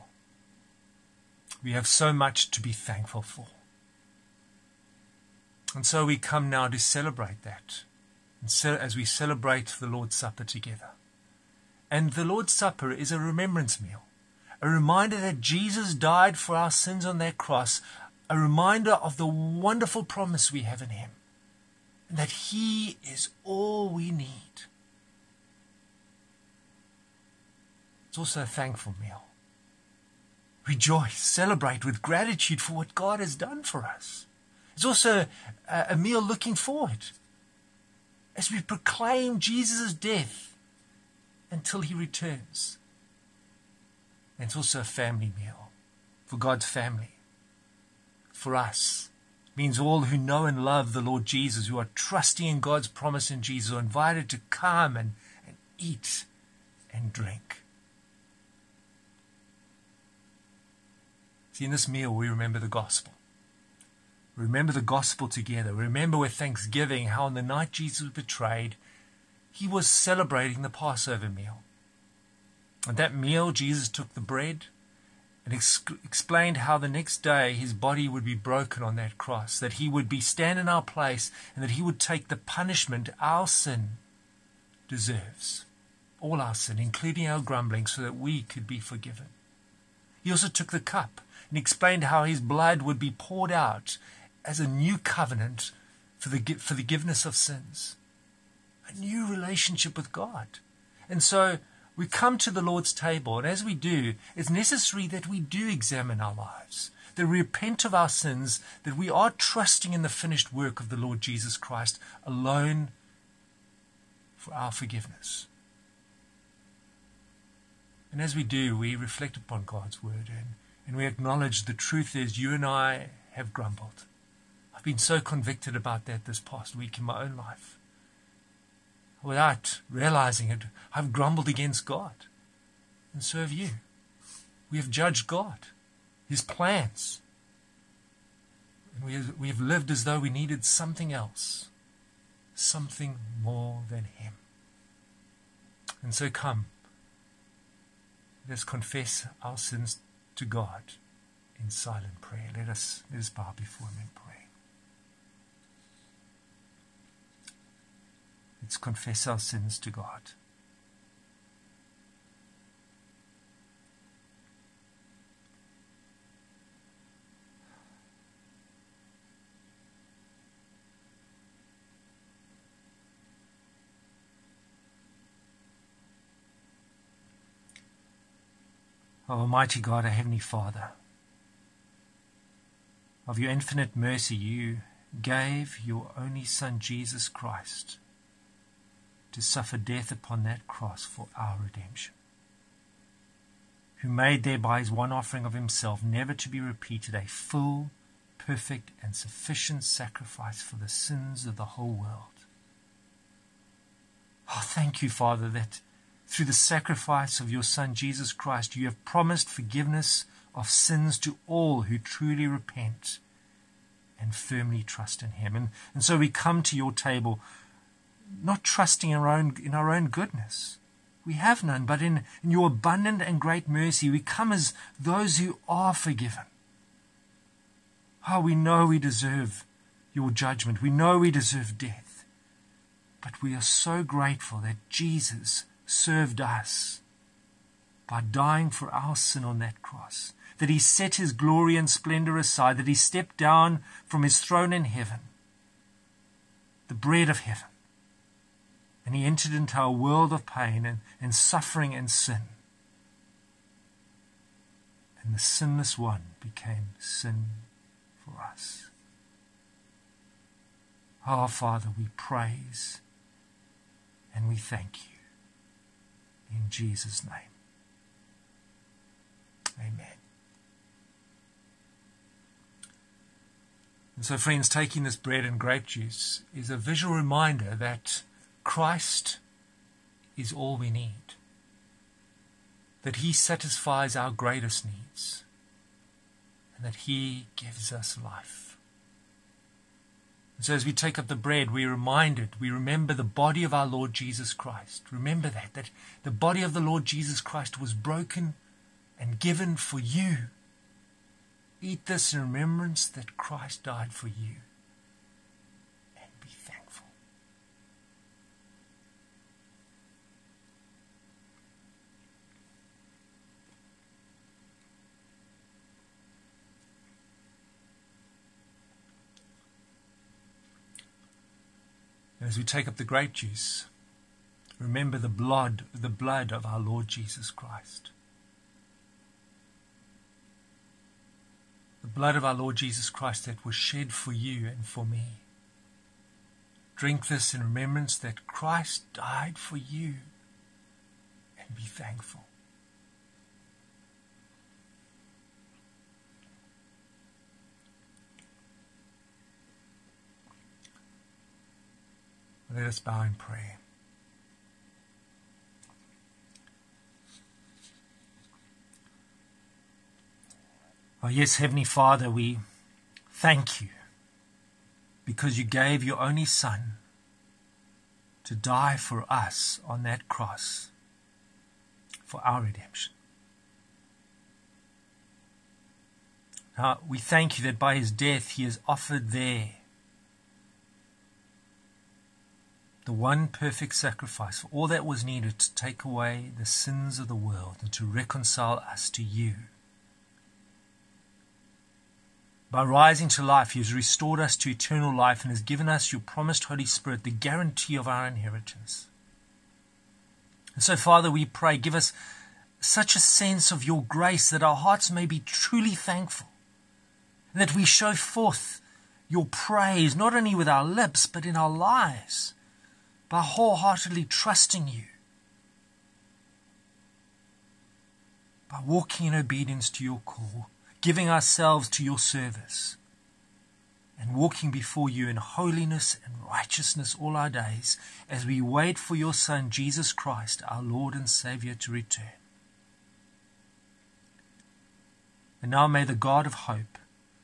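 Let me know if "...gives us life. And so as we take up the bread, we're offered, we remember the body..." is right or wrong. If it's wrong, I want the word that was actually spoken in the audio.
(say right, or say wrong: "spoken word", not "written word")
wrong: "reminded", not "offered".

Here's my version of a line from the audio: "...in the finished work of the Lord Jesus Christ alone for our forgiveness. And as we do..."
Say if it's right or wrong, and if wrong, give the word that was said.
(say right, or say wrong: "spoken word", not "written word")
right.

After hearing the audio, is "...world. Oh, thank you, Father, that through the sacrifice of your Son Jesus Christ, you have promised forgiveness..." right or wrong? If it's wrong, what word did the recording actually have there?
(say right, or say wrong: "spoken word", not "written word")
right.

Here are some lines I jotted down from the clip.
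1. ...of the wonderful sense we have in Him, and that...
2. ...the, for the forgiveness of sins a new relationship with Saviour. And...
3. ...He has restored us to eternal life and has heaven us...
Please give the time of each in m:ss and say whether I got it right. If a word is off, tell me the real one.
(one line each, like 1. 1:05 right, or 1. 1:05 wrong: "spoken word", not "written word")
1. 0:18 wrong: "promise", not "sense"
2. 1:36 wrong: "God", not "Saviour"
3. 6:33 wrong: "given", not "heaven".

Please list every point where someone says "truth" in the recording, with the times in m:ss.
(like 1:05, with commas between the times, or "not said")
2:01.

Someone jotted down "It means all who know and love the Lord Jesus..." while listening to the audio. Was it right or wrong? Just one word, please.
right.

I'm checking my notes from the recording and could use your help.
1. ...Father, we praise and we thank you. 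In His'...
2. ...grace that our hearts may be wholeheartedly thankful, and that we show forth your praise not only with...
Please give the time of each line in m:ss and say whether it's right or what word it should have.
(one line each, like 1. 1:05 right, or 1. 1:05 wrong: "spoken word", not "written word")
1. 4:21 wrong: "Jesus", not "His"
2. 6:44 wrong: "truly", not "wholeheartedly".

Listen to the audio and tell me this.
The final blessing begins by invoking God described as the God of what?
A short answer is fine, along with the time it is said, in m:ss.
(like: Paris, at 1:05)
hope, at 7:16.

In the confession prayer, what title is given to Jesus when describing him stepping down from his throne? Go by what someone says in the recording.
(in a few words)
the bread of heaven.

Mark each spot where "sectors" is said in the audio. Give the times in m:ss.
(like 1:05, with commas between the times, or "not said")
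not said.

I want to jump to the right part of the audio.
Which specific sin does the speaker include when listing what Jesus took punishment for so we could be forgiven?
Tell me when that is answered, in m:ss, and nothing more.
1:27.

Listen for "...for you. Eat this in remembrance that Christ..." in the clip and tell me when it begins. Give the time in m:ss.
4:59.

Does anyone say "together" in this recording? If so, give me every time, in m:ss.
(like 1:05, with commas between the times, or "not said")
0:10, 1:05.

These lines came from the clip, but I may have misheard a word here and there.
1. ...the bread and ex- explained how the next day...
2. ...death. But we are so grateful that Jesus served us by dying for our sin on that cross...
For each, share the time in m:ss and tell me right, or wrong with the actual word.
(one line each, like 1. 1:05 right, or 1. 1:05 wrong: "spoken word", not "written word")
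1. 1:14 right
2. 3:51 right.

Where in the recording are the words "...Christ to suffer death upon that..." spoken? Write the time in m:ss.
3:07.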